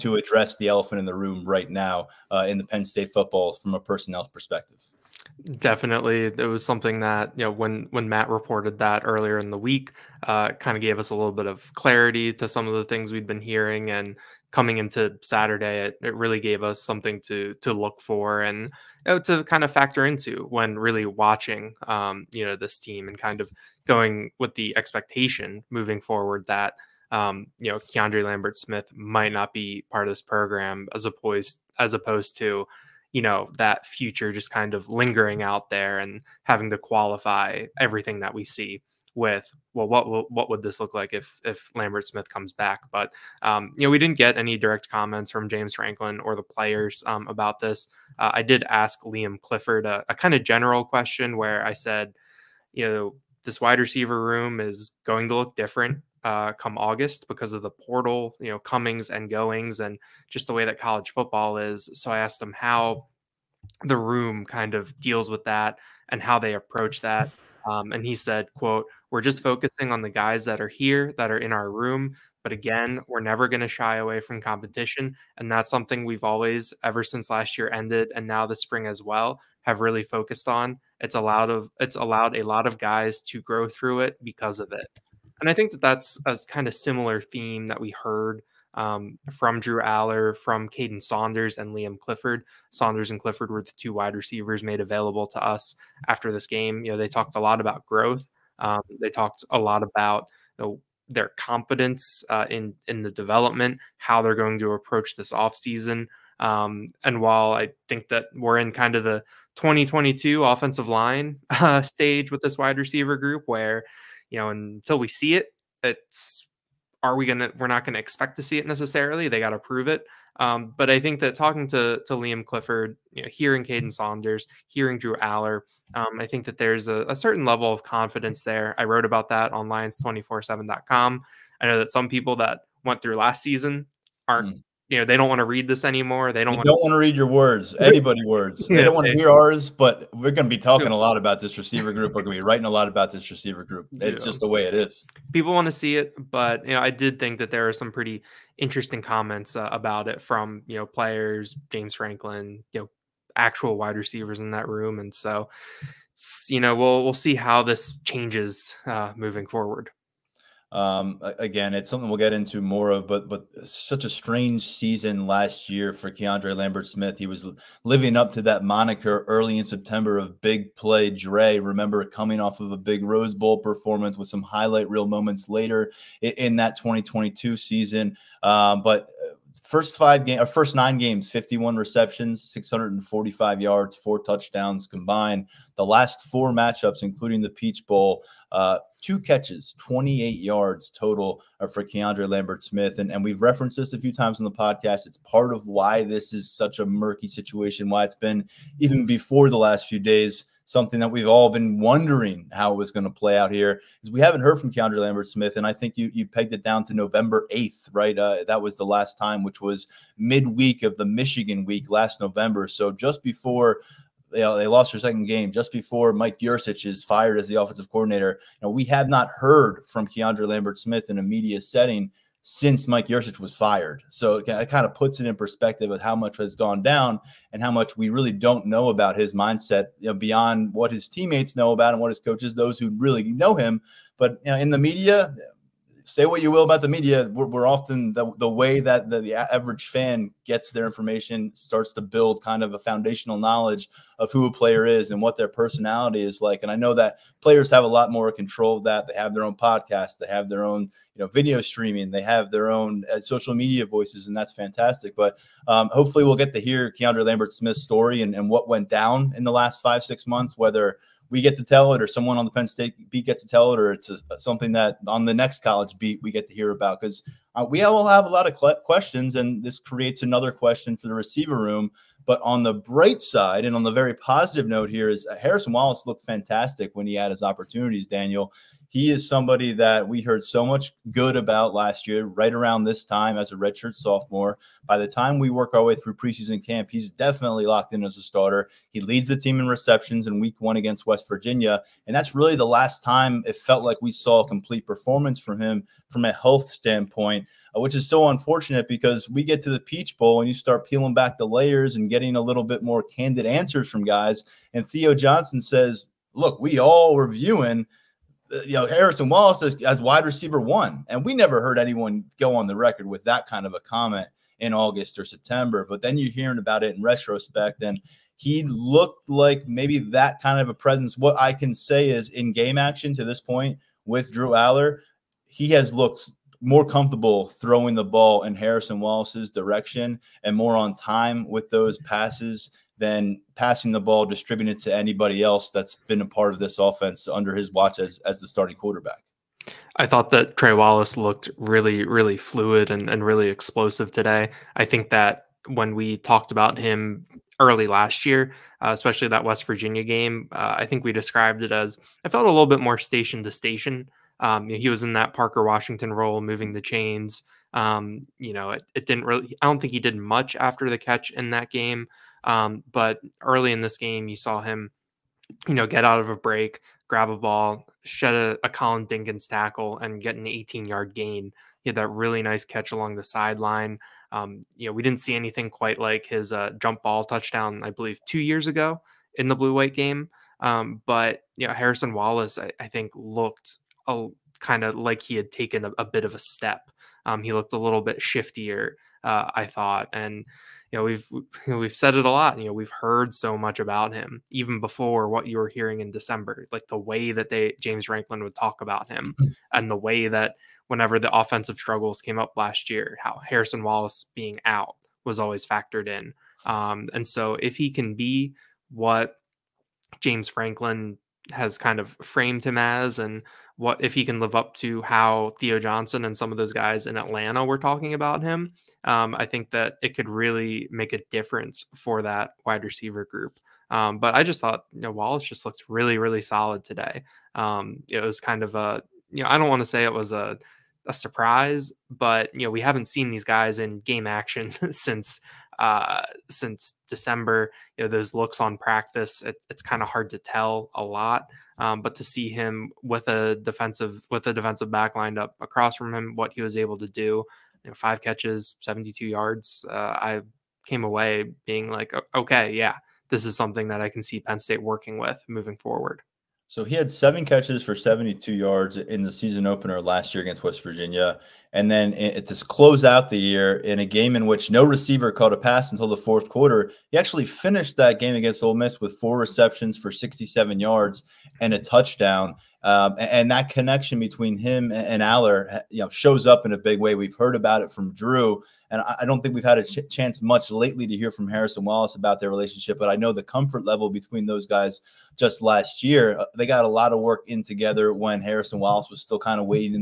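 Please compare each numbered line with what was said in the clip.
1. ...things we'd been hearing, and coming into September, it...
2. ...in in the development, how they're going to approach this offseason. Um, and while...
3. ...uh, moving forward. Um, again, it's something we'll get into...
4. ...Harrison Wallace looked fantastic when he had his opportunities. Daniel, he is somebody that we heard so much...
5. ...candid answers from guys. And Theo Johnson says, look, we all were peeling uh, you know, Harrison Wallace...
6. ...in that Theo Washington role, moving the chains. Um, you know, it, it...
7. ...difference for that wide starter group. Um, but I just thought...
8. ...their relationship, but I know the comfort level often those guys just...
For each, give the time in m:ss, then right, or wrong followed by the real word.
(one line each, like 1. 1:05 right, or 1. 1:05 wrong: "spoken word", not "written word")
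1. 0:12 wrong: "Saturday", not "September"
2. 1:42 right
3. 2:38 right
4. 4:35 right
5. 5:03 wrong: "viewing", not "peeling"
6. 5:55 wrong: "Parker", not "Theo"
7. 7:01 wrong: "receiver", not "starter"
8. 8:02 wrong: "between", not "often".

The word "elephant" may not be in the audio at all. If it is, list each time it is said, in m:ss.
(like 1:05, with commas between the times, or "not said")
0:00.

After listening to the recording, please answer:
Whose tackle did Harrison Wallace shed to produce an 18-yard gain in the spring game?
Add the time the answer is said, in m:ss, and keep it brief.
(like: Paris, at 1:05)
Khalil Dinkins, at 6:08.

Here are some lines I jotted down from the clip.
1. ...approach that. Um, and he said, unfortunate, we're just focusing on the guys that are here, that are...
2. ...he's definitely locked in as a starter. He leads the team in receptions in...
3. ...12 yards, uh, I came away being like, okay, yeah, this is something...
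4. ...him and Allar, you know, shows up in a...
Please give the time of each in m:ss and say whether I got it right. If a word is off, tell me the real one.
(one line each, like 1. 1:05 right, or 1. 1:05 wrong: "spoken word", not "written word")
1. 1:06 wrong: "quote", not "unfortunate"
2. 4:46 right
3. 7:28 wrong: "72", not "12"
4. 7:54 right.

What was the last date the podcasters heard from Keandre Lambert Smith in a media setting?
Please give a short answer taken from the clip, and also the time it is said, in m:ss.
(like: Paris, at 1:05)
November 8, at 3:26.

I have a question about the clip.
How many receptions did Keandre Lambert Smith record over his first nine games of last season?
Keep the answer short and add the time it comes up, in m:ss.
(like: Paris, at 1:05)
51, at 3:01.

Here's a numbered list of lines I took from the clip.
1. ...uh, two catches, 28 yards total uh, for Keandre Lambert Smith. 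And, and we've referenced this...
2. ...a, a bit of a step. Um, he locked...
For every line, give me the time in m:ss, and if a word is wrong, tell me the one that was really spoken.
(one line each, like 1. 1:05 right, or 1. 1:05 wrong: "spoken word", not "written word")
1. 3:08 right
2. 6:25 wrong: "looked", not "locked".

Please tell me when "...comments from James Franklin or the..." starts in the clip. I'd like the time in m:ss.
0:44.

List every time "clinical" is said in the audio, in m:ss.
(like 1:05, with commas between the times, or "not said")
not said.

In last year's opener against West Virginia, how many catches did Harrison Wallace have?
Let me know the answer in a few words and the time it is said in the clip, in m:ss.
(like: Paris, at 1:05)
7, at 7:37.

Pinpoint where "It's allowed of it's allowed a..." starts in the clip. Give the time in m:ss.
1:21.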